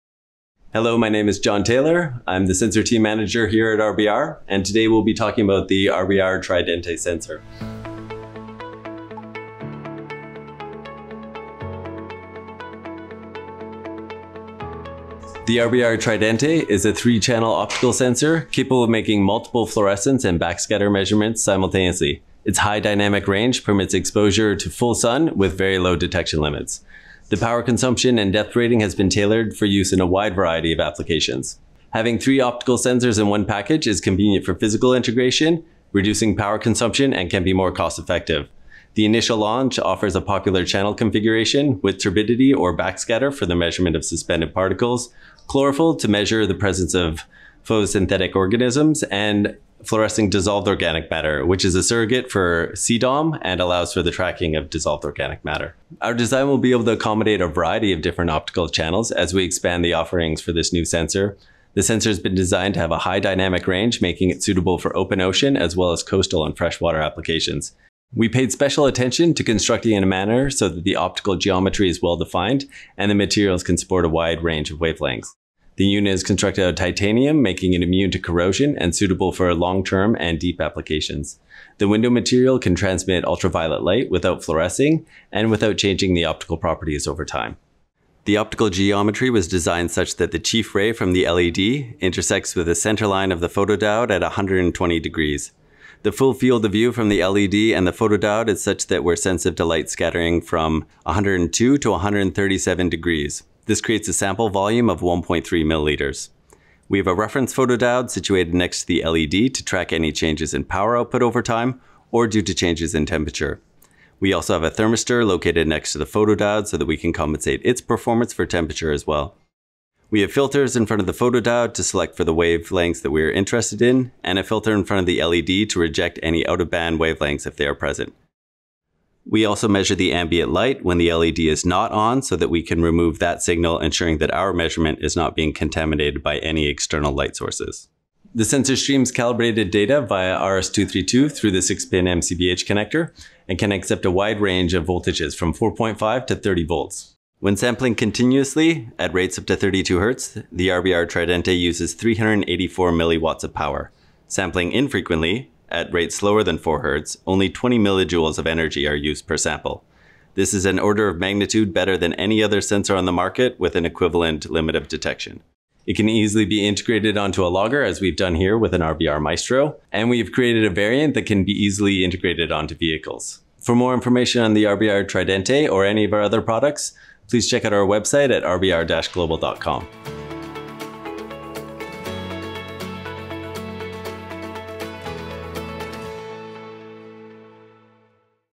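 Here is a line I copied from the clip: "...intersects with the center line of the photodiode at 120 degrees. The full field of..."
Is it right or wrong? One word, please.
right.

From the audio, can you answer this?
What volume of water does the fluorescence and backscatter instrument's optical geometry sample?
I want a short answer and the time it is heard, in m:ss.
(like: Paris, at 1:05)
1.3 milliliters, at 1:44.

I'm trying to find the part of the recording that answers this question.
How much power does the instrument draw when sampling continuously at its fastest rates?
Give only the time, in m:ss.
2:31.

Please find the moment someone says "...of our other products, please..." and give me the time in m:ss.
2:56.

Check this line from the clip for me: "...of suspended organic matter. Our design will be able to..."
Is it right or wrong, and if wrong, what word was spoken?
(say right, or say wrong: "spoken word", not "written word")
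wrong: "dissolved", not "suspended".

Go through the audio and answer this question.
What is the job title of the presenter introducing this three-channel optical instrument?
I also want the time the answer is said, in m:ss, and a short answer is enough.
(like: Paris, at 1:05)
Sensor team manager, at 0:02.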